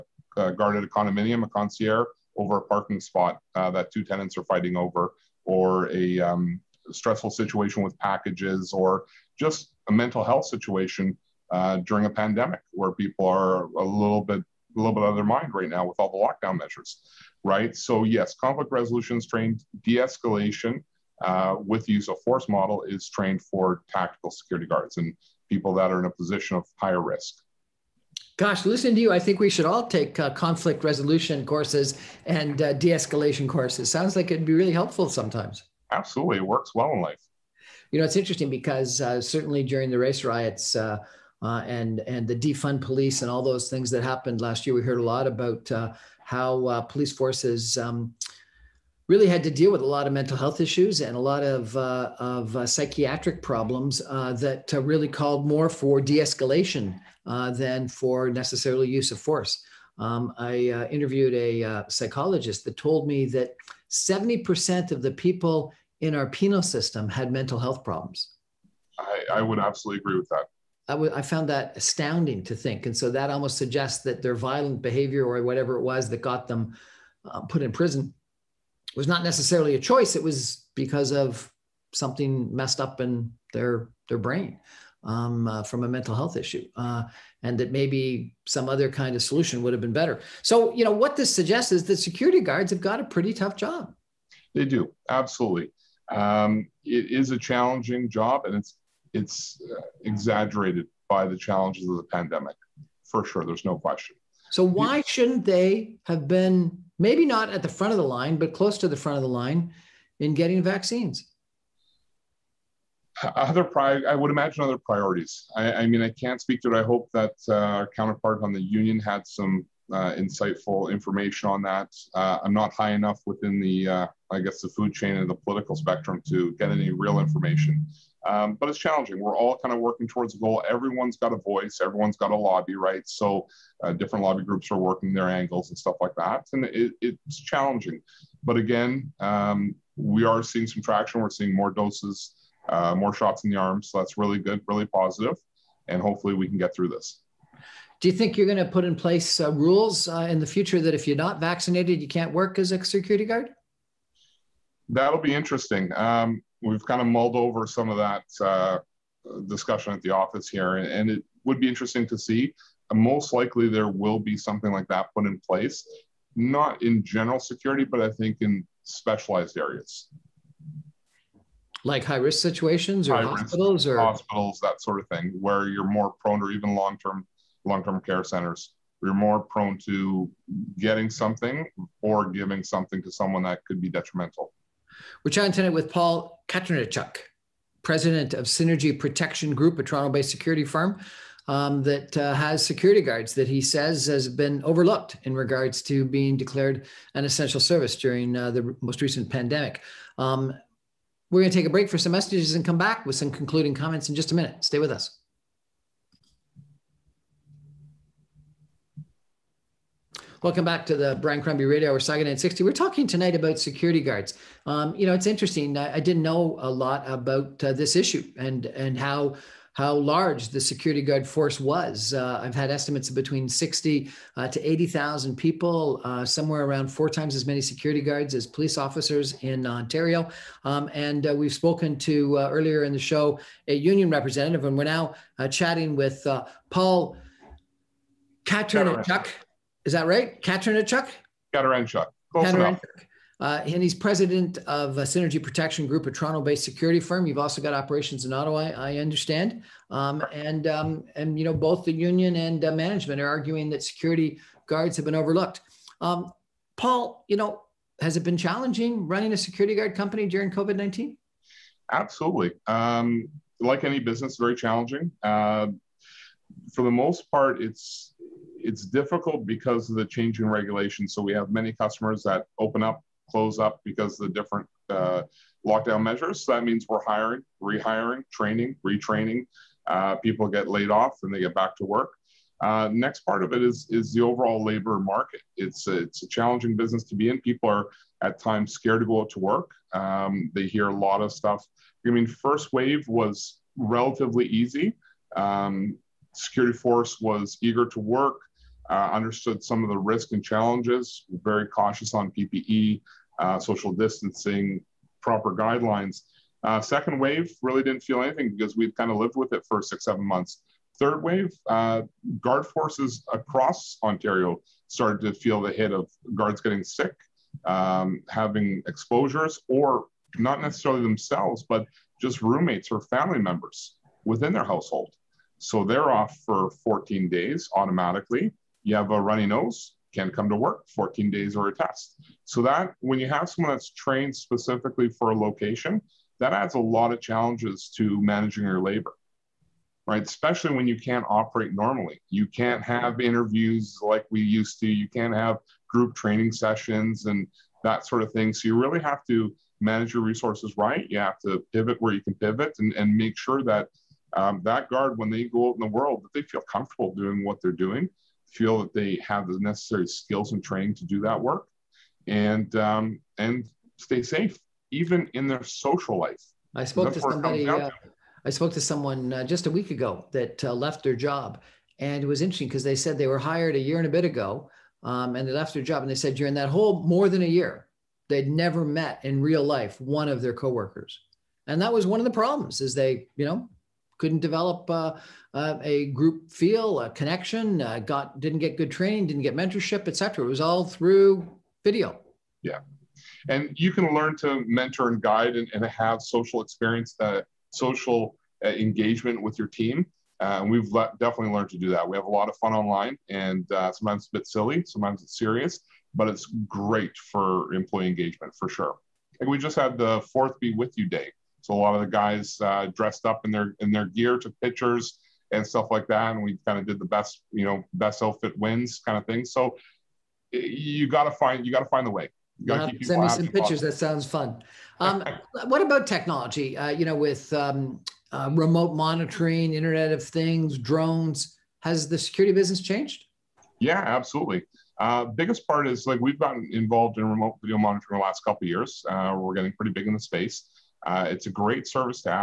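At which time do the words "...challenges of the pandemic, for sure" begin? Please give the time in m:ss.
1:41.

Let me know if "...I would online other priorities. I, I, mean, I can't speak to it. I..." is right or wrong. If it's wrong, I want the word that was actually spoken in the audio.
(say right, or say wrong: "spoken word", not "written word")
wrong: "imagine", not "online".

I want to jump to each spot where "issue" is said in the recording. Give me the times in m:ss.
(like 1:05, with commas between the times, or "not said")
0:50, 1:26, 3:37.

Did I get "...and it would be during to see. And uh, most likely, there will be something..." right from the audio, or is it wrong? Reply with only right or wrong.
wrong.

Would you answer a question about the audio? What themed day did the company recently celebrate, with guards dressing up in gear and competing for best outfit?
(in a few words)
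Be With You Day.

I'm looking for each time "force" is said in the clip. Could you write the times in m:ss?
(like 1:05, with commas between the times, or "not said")
0:22, 0:47, 0:59, 3:41, 4:56, 5:12.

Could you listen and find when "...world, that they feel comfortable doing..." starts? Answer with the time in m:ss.
5:55.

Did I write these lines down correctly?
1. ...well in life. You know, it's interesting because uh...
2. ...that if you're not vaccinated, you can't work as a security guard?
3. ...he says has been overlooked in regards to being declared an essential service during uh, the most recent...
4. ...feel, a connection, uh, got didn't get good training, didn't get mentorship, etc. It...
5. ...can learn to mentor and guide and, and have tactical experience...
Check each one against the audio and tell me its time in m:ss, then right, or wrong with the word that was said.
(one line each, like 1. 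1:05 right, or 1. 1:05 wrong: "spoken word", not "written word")
1. 0:36 right
2. 2:30 right
3. 3:13 right
4. 6:26 right
5. 6:33 wrong: "social", not "tactical".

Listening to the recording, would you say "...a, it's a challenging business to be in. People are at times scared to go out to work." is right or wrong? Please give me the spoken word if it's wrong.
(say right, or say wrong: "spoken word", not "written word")
right.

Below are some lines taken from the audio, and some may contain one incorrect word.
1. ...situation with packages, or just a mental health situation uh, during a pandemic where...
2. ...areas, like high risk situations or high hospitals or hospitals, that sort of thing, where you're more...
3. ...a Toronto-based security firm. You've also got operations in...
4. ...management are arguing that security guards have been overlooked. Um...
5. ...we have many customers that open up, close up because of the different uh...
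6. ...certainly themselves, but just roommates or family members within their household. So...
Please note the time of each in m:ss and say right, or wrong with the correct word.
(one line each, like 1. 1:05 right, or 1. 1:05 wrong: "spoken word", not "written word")
1. 0:07 right
2. 2:49 right
3. 4:06 right
4. 4:12 right
5. 4:31 right
6. 5:20 wrong: "necessarily", not "certainly".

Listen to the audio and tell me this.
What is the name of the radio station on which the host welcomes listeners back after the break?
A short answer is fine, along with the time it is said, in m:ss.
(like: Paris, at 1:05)
Sauga 960, at 3:31.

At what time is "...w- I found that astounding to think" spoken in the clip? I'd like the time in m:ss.
1:10.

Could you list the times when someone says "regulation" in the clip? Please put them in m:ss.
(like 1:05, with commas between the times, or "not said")
4:30.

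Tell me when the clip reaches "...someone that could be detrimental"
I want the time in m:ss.
3:03.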